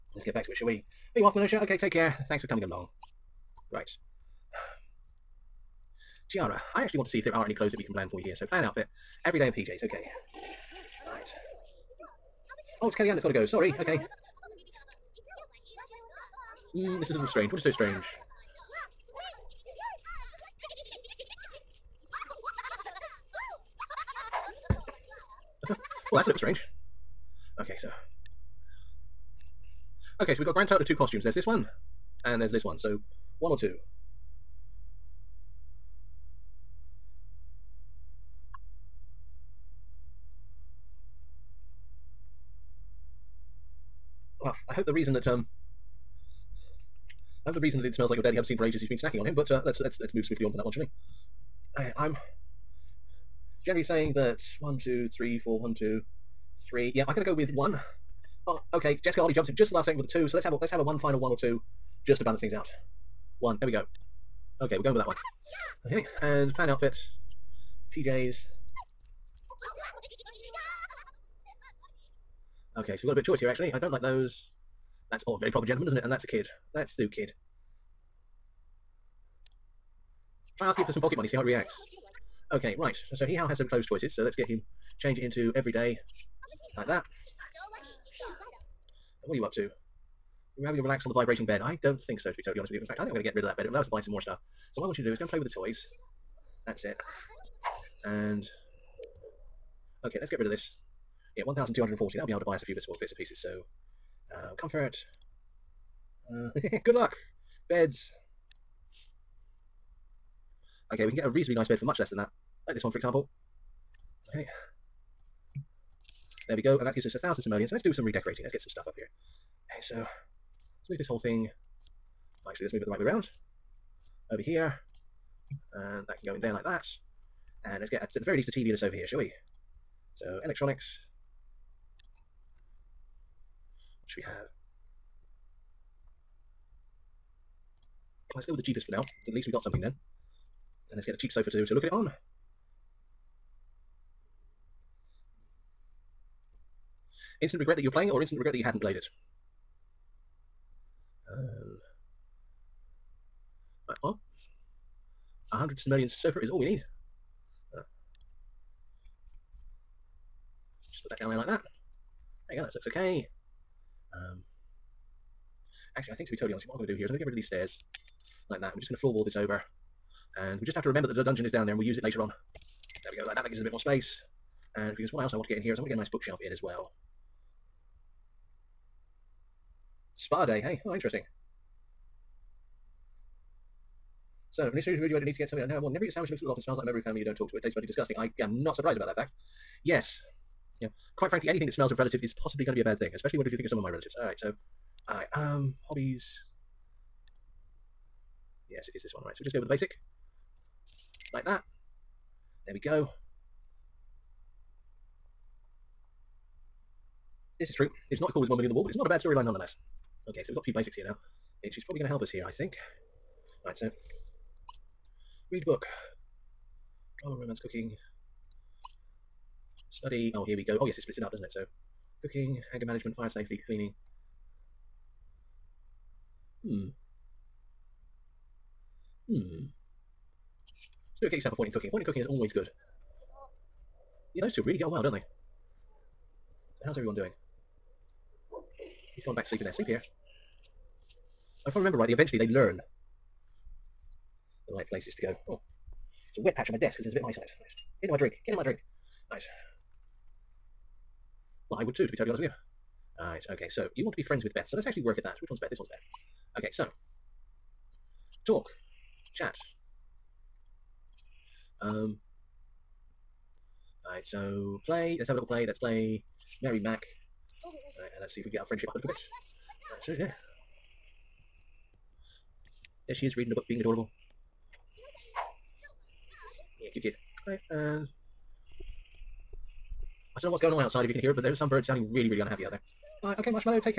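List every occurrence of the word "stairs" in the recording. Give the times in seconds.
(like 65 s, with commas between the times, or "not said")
167 s.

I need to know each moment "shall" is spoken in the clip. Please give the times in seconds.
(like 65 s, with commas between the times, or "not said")
0 s, 50 s, 129 s.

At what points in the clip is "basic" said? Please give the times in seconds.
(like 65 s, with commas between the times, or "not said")
199 s, 210 s.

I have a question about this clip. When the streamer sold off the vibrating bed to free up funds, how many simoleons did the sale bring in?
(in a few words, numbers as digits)
1,240.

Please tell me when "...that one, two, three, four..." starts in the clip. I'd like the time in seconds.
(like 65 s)
54 s.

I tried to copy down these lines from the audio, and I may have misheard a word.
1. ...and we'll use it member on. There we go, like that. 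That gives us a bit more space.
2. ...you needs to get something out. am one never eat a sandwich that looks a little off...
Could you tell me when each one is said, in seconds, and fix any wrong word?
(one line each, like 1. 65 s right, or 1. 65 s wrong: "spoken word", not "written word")
1. 171 s wrong: "later", not "member"
2. 185 s right.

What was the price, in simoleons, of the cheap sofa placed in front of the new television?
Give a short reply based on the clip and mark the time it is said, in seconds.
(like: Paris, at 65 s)
100, at 155 s.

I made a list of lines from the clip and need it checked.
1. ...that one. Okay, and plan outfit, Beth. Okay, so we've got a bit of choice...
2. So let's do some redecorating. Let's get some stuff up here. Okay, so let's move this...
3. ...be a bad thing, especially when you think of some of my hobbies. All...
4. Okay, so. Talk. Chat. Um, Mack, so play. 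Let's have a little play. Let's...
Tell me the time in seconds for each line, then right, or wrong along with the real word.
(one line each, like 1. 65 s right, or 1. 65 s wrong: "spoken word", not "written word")
1. 64 s wrong: "PJs", not "Beth"
2. 117 s right
3. 192 s wrong: "relatives", not "hobbies"
4. 256 s wrong: "Alright", not "Mack".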